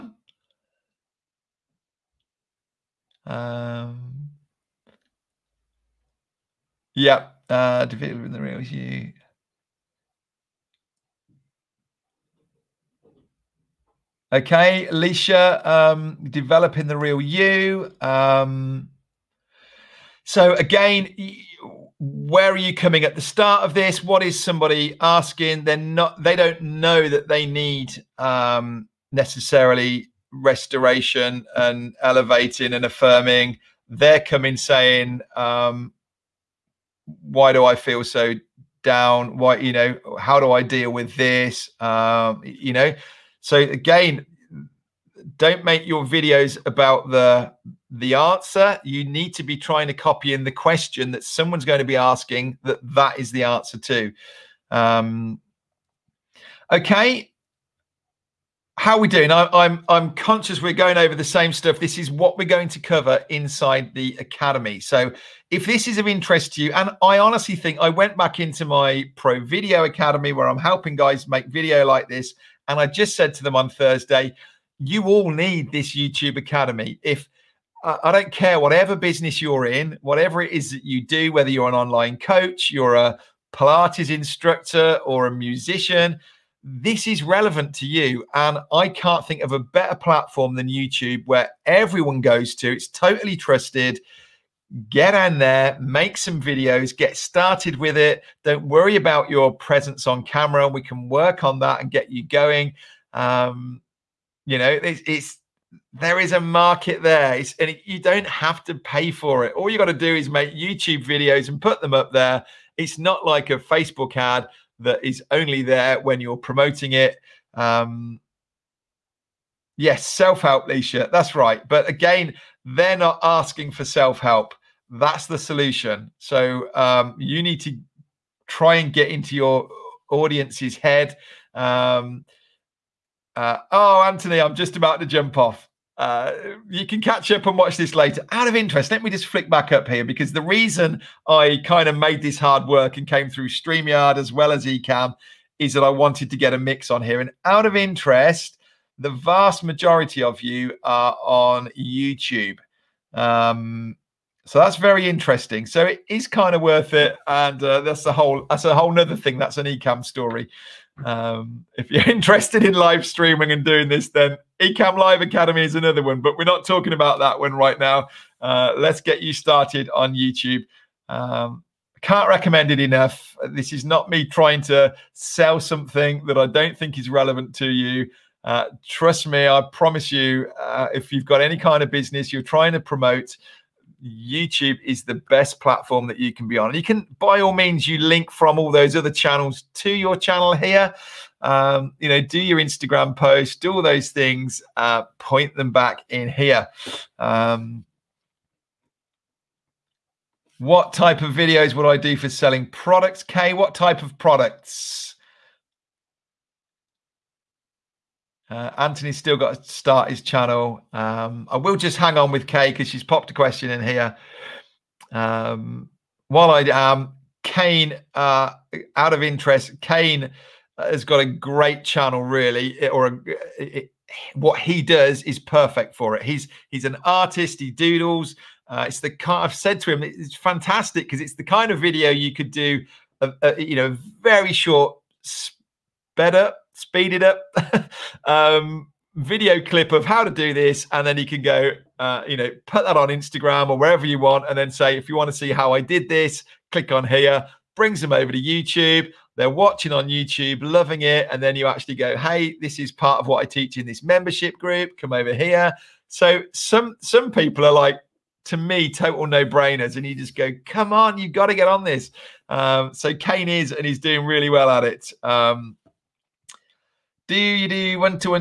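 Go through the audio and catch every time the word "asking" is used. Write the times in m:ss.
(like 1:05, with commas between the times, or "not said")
0:24, 0:51, 2:03.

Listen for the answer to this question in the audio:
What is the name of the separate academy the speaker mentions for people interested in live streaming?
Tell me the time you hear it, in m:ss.
2:44.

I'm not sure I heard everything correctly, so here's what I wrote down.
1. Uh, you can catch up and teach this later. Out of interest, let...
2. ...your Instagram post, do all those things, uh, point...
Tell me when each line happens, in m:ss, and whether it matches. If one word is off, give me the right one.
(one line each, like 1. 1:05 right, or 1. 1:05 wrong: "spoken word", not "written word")
1. 2:15 wrong: "watch", not "teach"
2. 3:12 right.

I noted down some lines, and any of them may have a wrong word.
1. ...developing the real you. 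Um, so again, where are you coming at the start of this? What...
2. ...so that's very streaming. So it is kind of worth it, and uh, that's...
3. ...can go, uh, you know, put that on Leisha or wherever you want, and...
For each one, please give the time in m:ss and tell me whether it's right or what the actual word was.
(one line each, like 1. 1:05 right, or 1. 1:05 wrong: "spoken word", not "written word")
1. 0:16 right
2. 2:34 wrong: "interesting", not "streaming"
3. 4:01 wrong: "Instagram", not "Leisha".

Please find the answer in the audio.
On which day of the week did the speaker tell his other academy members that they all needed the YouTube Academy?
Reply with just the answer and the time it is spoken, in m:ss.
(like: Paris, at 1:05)
Thursday, at 1:13.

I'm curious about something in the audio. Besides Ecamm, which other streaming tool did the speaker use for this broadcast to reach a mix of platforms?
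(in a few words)
StreamYard.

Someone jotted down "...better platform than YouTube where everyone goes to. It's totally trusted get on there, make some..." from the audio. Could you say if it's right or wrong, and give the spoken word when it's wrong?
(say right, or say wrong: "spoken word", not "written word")
right.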